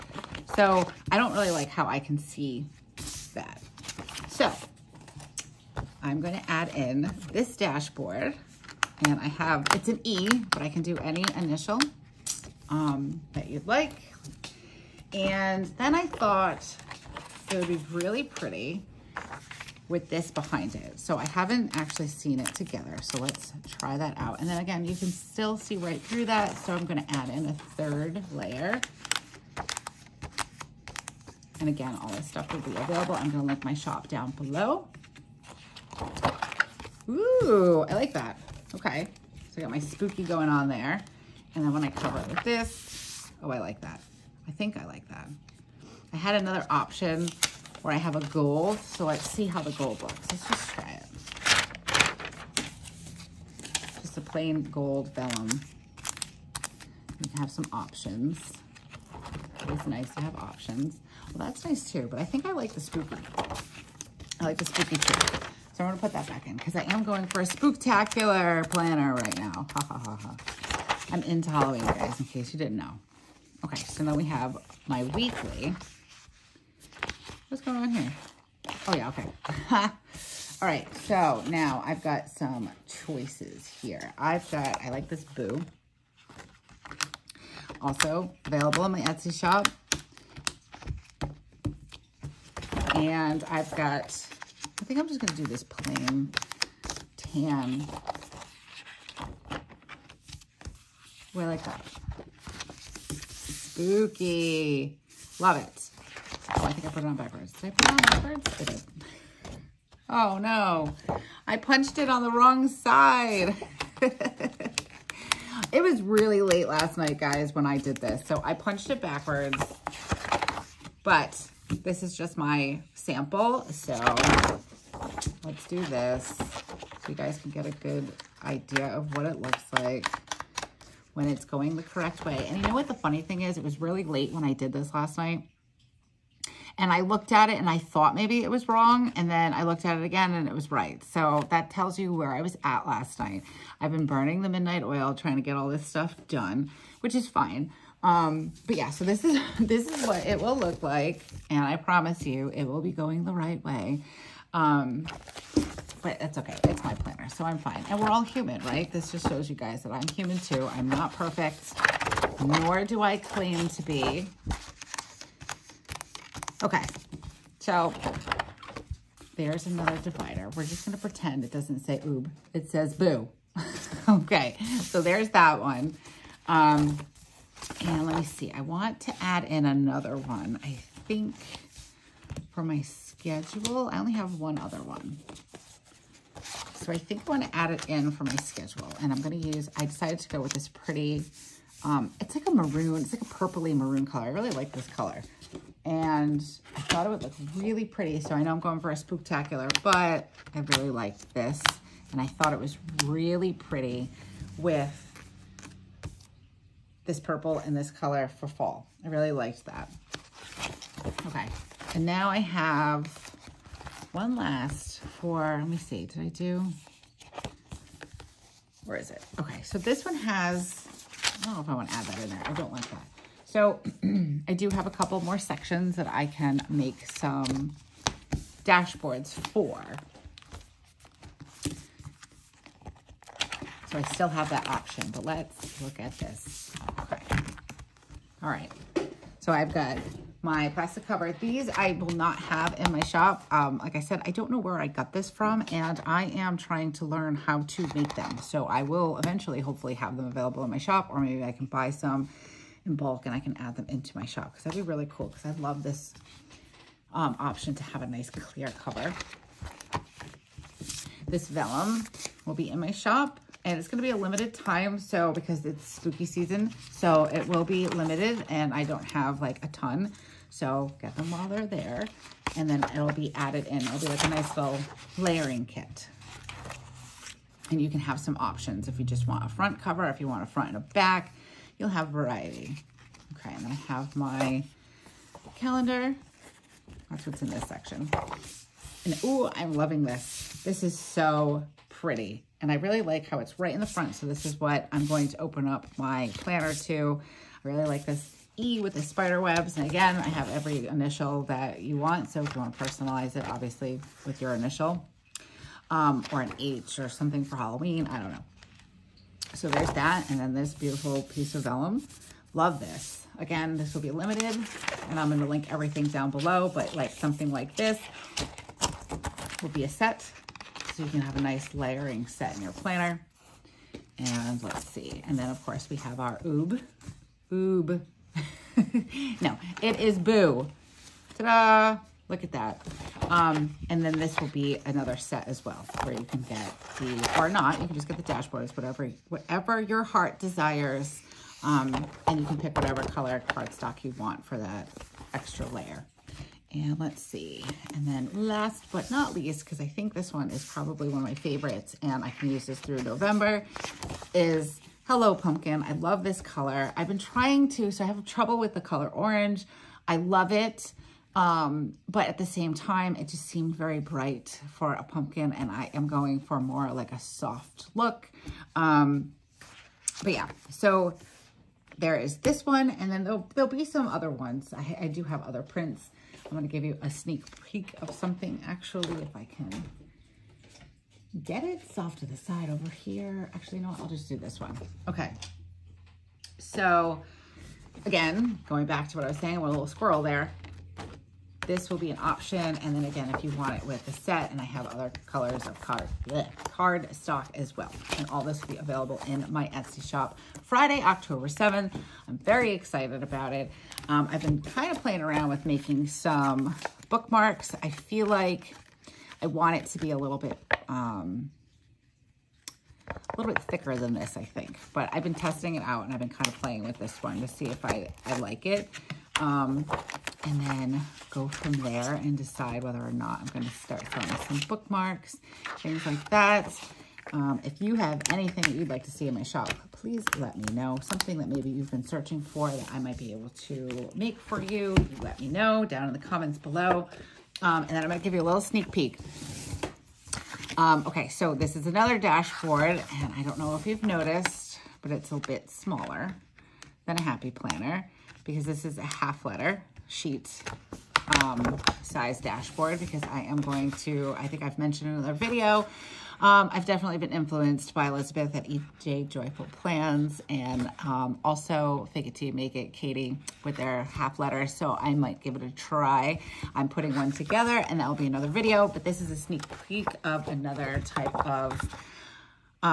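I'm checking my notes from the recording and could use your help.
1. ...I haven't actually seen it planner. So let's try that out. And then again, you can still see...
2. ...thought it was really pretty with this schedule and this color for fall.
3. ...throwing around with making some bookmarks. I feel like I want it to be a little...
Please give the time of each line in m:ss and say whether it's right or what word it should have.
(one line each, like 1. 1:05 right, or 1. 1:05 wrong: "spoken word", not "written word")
1. 0:21 wrong: "together", not "planner"
2. 3:22 wrong: "purple", not "schedule"
3. 6:45 wrong: "playing", not "throwing".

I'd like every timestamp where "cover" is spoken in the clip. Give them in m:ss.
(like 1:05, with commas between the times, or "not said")
0:41, 4:01, 4:18, 4:39.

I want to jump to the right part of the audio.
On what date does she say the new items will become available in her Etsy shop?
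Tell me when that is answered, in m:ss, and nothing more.
6:40.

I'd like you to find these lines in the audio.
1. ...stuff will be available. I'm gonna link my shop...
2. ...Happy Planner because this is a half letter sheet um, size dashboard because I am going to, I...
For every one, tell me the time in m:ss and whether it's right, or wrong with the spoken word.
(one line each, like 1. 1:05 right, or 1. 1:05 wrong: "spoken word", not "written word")
1. 0:32 right
2. 7:27 right.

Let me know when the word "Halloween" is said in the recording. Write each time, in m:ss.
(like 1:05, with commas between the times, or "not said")
1:11, 5:07.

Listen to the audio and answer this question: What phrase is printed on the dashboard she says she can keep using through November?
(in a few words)
Hello Pumpkin.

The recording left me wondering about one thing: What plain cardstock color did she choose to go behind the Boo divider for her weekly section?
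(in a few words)
Tan.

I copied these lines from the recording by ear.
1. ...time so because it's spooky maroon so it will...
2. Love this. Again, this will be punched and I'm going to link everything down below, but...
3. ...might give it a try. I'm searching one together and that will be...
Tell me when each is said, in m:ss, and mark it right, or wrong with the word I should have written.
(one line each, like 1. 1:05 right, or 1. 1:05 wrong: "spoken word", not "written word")
1. 4:24 wrong: "season", not "maroon"
2. 5:12 wrong: "limited", not "punched"
3. 7:45 wrong: "putting", not "searching".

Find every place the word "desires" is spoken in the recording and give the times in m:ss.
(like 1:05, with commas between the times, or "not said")
5:40.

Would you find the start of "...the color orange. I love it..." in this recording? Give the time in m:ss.
5:58.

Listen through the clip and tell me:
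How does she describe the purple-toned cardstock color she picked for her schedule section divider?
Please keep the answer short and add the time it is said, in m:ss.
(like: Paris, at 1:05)
Purpley maroon, at 3:13.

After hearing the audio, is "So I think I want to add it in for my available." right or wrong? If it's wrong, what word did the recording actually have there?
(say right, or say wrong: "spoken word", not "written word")
wrong: "schedule", not "available".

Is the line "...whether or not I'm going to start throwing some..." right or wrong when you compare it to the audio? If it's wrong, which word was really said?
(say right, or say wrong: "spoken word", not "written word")
right.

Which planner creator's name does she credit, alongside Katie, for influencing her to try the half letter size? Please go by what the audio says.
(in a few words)
Elizabeth.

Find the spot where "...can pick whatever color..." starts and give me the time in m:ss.
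5:42.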